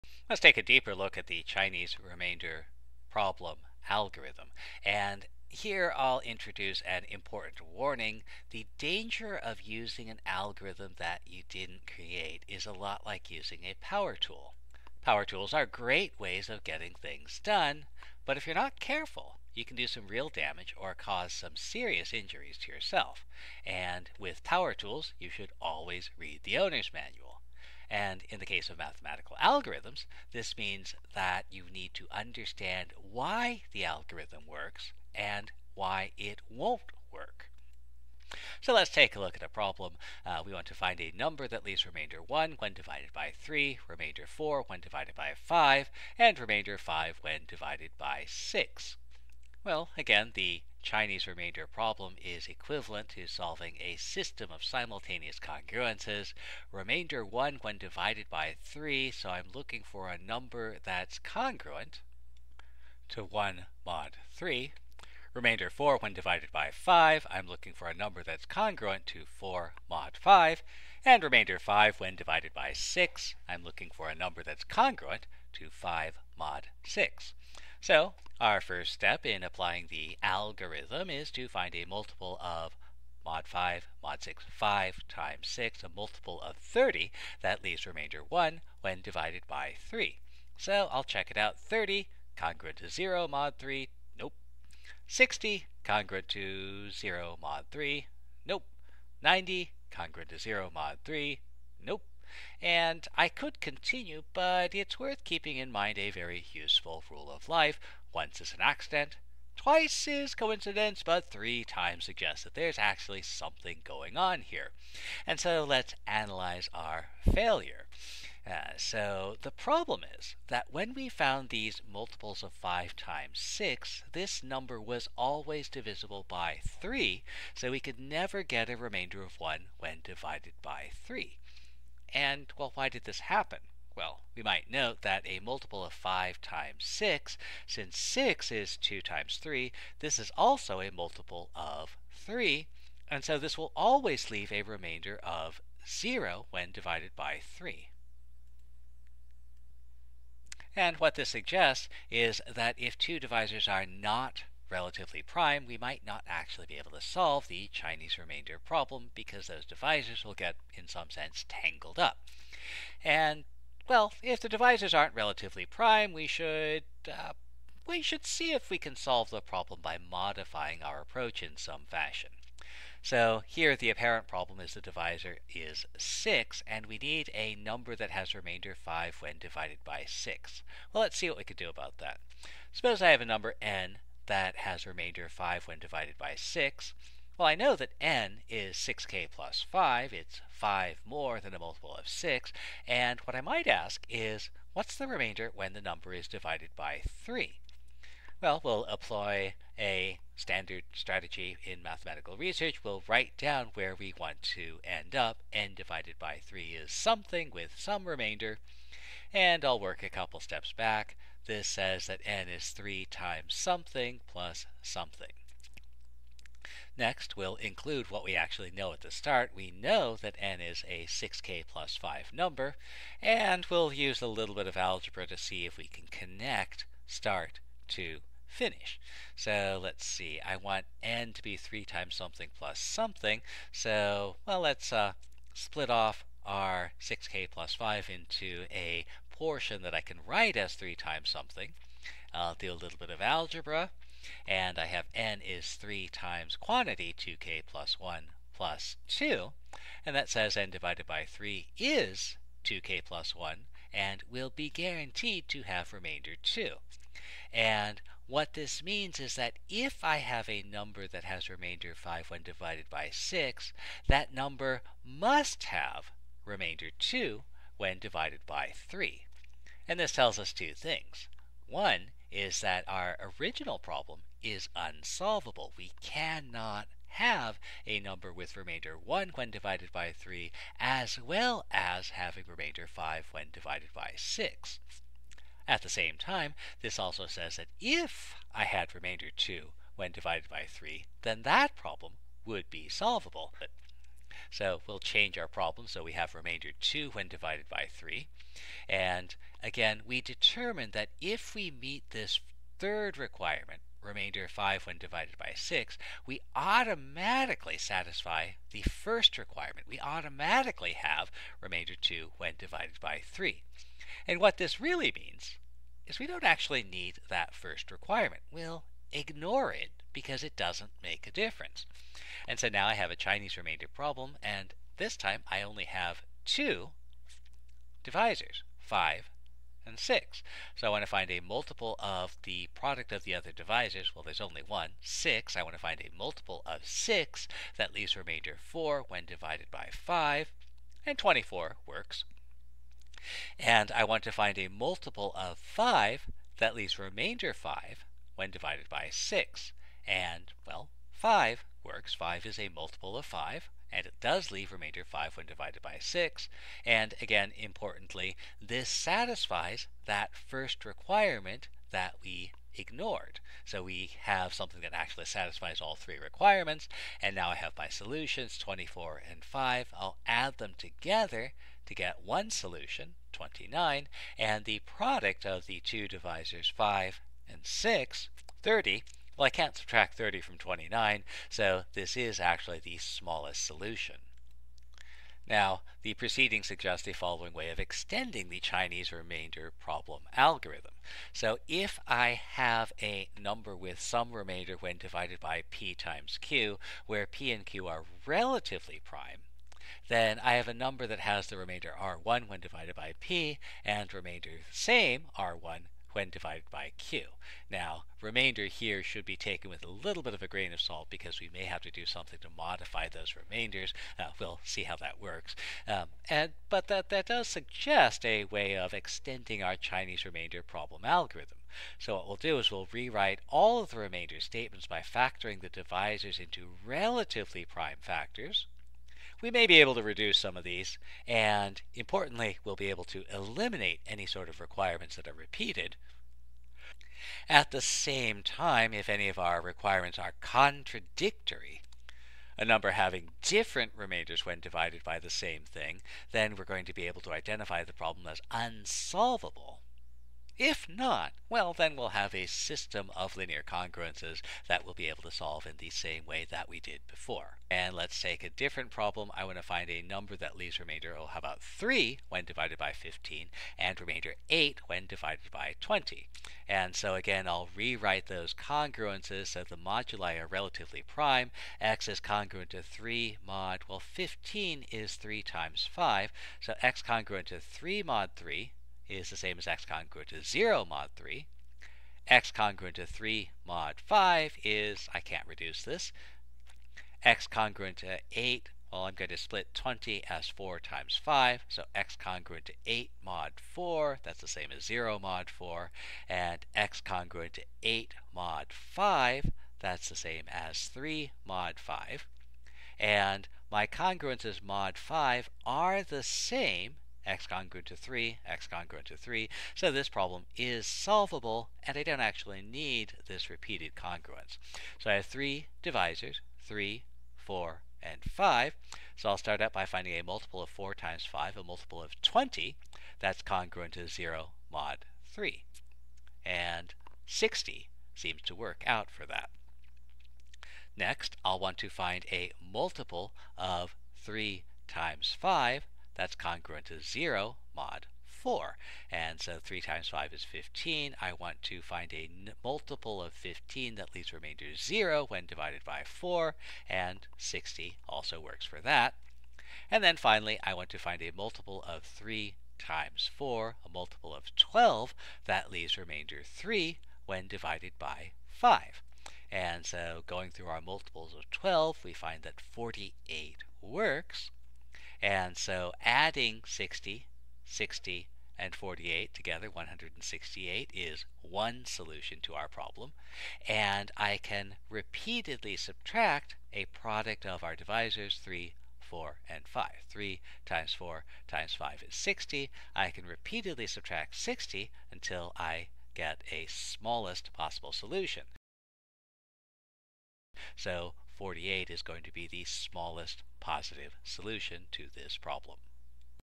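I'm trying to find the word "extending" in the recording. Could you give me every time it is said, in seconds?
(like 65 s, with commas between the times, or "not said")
387 s, 418 s.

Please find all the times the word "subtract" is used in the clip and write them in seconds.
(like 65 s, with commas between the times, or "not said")
379 s, 575 s, 583 s.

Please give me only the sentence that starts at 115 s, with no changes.
And so let's analyze our failure.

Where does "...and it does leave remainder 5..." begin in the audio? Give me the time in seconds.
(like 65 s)
353 s.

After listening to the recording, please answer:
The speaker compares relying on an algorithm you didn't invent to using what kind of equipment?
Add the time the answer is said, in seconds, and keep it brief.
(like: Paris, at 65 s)
power tool, at 13 s.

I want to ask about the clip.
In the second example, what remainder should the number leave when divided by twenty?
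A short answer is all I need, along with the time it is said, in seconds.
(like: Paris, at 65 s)
8, at 463 s.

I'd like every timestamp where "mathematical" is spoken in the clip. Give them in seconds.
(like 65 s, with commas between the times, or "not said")
28 s, 201 s.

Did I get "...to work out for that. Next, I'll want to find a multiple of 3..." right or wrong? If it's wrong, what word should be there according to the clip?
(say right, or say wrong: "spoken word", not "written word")
right.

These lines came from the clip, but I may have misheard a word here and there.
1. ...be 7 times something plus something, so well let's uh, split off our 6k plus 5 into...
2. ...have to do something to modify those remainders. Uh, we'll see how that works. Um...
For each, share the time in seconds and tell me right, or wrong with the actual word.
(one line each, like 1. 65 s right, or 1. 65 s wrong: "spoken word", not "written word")
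1. 231 s wrong: "3", not "7"
2. 411 s right.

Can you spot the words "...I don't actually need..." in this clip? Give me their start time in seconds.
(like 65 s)
511 s.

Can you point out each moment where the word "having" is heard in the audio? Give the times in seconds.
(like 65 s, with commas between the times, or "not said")
282 s, 442 s.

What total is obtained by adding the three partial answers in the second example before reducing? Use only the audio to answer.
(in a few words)
168.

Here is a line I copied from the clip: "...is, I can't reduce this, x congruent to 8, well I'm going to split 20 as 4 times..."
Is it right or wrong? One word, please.
right.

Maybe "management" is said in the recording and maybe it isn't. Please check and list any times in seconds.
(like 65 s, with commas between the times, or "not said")
not said.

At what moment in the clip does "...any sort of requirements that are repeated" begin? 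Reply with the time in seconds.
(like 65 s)
434 s.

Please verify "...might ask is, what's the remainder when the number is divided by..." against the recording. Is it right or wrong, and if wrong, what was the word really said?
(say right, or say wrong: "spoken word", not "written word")
right.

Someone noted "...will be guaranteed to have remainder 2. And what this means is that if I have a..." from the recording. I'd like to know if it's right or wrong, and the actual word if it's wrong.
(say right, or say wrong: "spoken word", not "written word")
right.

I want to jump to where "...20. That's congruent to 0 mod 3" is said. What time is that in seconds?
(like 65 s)
522 s.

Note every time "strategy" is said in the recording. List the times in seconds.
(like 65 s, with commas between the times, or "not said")
200 s.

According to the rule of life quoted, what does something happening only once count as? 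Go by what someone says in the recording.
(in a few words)
an accident.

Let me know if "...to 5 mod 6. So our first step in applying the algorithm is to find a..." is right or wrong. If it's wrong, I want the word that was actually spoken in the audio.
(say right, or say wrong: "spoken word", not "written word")
right.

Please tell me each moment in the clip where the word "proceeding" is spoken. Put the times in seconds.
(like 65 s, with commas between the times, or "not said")
386 s.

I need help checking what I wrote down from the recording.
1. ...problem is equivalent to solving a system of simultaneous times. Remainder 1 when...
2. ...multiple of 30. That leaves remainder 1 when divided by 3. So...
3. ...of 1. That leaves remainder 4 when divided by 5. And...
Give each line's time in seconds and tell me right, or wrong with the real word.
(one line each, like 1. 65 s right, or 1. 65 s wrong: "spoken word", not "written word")
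1. 51 s wrong: "congruences", not "times"
2. 85 s right
3. 336 s wrong: "6", not "1".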